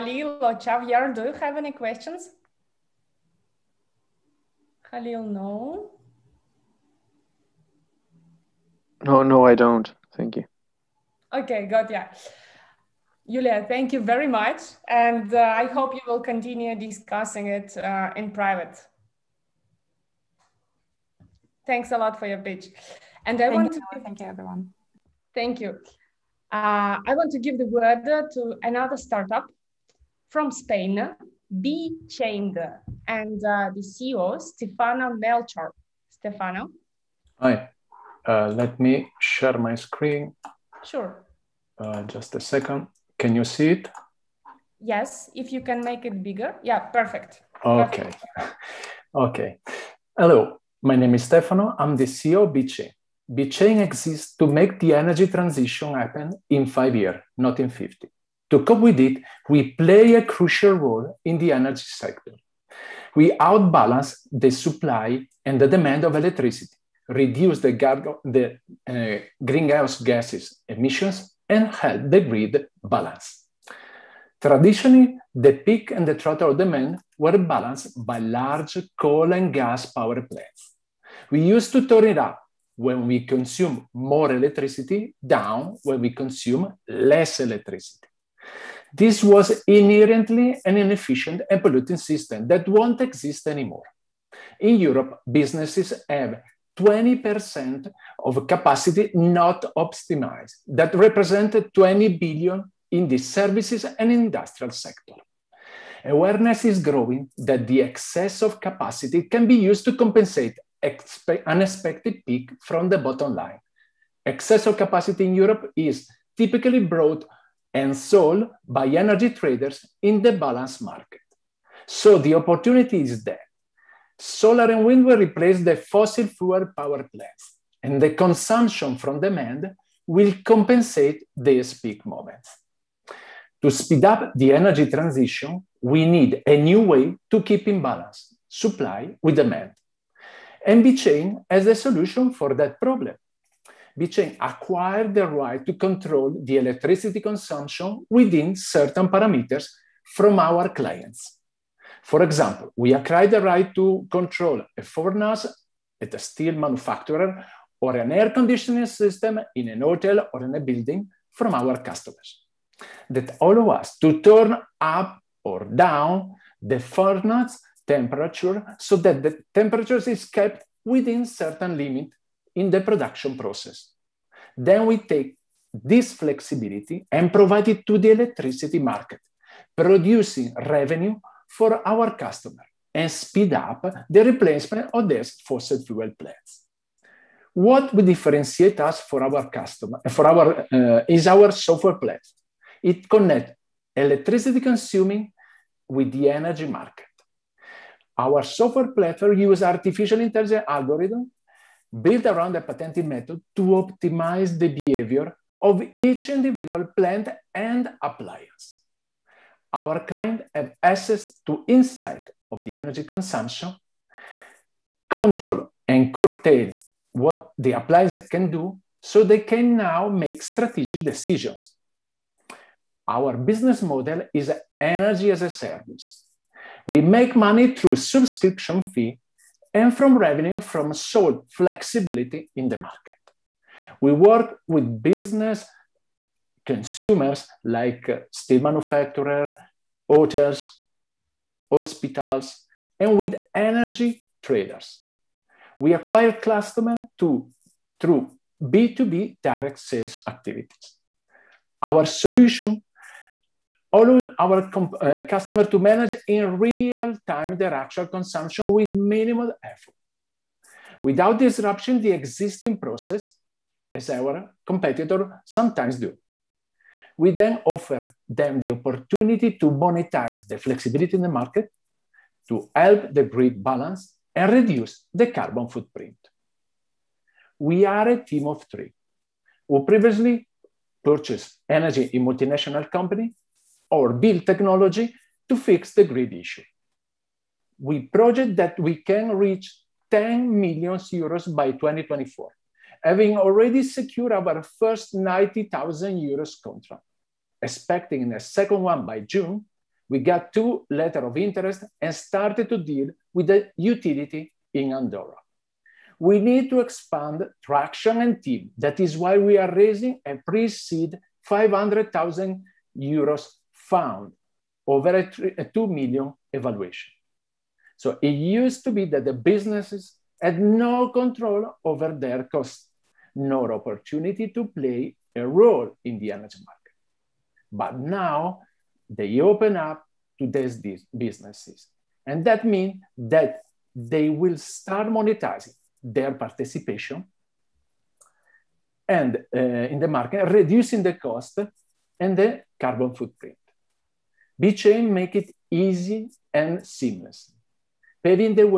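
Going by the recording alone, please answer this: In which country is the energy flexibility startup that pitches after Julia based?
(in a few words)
Spain.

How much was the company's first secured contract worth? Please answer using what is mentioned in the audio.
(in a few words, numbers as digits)
90,000 euros.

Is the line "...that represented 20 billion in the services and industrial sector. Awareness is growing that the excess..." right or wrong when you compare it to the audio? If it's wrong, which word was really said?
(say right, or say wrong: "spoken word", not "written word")
right.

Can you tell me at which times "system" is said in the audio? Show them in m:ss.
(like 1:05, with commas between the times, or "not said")
1:31, 2:38.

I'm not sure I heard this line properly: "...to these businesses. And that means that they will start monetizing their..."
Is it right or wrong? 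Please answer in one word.
right.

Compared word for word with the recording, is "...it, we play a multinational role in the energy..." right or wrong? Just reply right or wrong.
wrong.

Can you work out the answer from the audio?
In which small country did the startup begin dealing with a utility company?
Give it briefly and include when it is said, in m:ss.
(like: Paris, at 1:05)
Andorra, at 5:04.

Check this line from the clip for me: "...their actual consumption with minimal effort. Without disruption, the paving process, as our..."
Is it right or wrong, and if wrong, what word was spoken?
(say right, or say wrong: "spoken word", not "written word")
wrong: "existing", not "paving".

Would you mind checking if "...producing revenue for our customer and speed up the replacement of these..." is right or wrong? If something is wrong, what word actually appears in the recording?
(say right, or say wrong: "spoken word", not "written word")
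right.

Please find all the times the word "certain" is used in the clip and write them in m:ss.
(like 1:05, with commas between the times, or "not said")
2:28, 2:51.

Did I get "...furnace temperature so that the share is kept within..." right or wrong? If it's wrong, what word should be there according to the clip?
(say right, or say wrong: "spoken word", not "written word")
wrong: "temperature", not "share".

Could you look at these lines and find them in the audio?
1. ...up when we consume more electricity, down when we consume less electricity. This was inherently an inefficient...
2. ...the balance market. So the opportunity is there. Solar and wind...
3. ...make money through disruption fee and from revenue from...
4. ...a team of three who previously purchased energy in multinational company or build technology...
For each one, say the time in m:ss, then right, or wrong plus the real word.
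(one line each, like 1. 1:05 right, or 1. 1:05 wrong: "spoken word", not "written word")
1. 1:22 right
2. 2:00 right
3. 3:47 wrong: "subscription", not "disruption"
4. 4:38 right.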